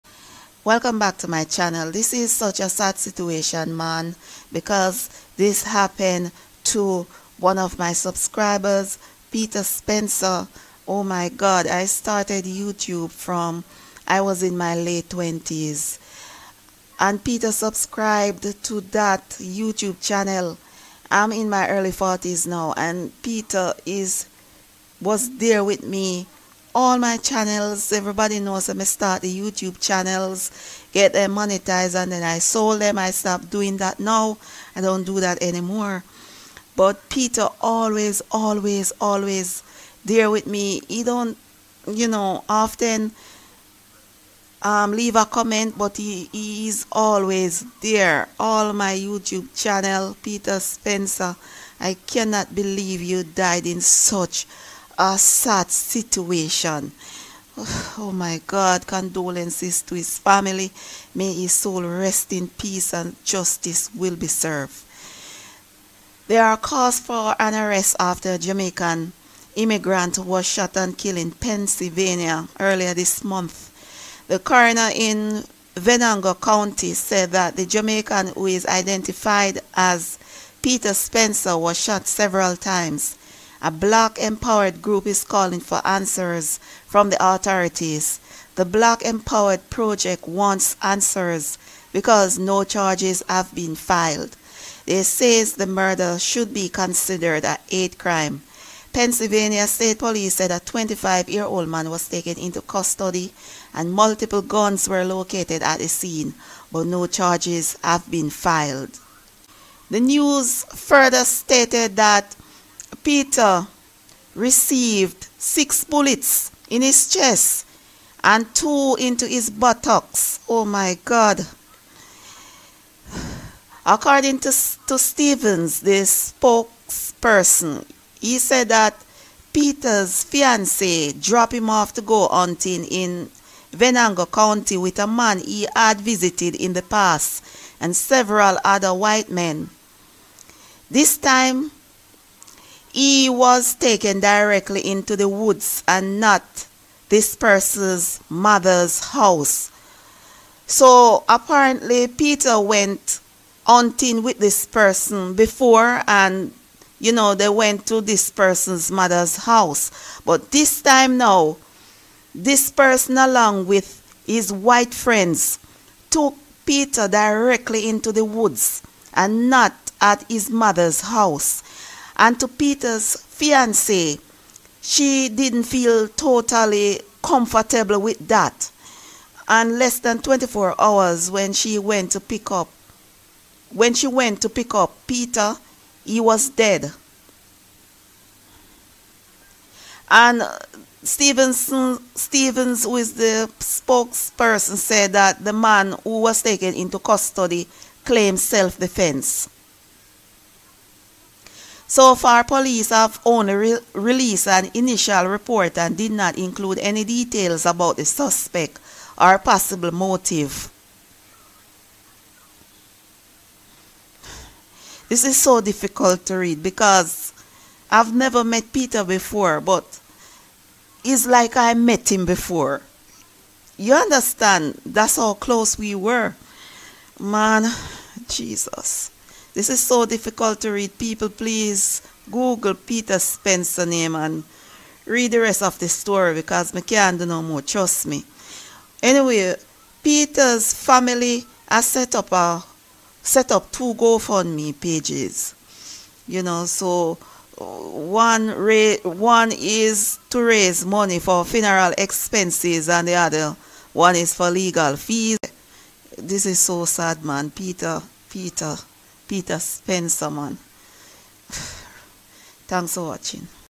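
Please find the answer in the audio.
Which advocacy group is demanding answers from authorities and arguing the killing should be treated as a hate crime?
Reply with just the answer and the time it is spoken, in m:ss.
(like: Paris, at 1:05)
Black Empowered Project, at 1:28.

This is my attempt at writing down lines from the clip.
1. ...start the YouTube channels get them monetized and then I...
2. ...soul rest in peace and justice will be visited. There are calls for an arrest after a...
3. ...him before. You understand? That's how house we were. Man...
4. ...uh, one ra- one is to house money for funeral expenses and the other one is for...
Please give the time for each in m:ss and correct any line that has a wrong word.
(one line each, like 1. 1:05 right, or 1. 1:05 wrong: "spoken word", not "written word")
1. 0:28 right
2. 1:01 wrong: "served", not "visited"
3. 3:42 wrong: "close", not "house"
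4. 4:07 wrong: "raise", not "house".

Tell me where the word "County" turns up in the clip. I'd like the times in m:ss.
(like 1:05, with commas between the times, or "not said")
1:16, 2:14.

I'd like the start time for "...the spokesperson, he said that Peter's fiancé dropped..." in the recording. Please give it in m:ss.
2:05.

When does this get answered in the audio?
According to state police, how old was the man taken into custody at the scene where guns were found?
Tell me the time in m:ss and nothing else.
1:40.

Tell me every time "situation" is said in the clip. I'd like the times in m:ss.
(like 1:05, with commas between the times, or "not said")
0:02, 0:55.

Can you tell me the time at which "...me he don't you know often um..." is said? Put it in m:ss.
0:40.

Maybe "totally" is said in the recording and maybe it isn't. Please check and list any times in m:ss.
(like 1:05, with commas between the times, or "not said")
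2:56.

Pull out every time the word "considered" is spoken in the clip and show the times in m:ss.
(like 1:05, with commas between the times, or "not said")
1:36.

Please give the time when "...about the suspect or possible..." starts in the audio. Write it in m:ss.
3:27.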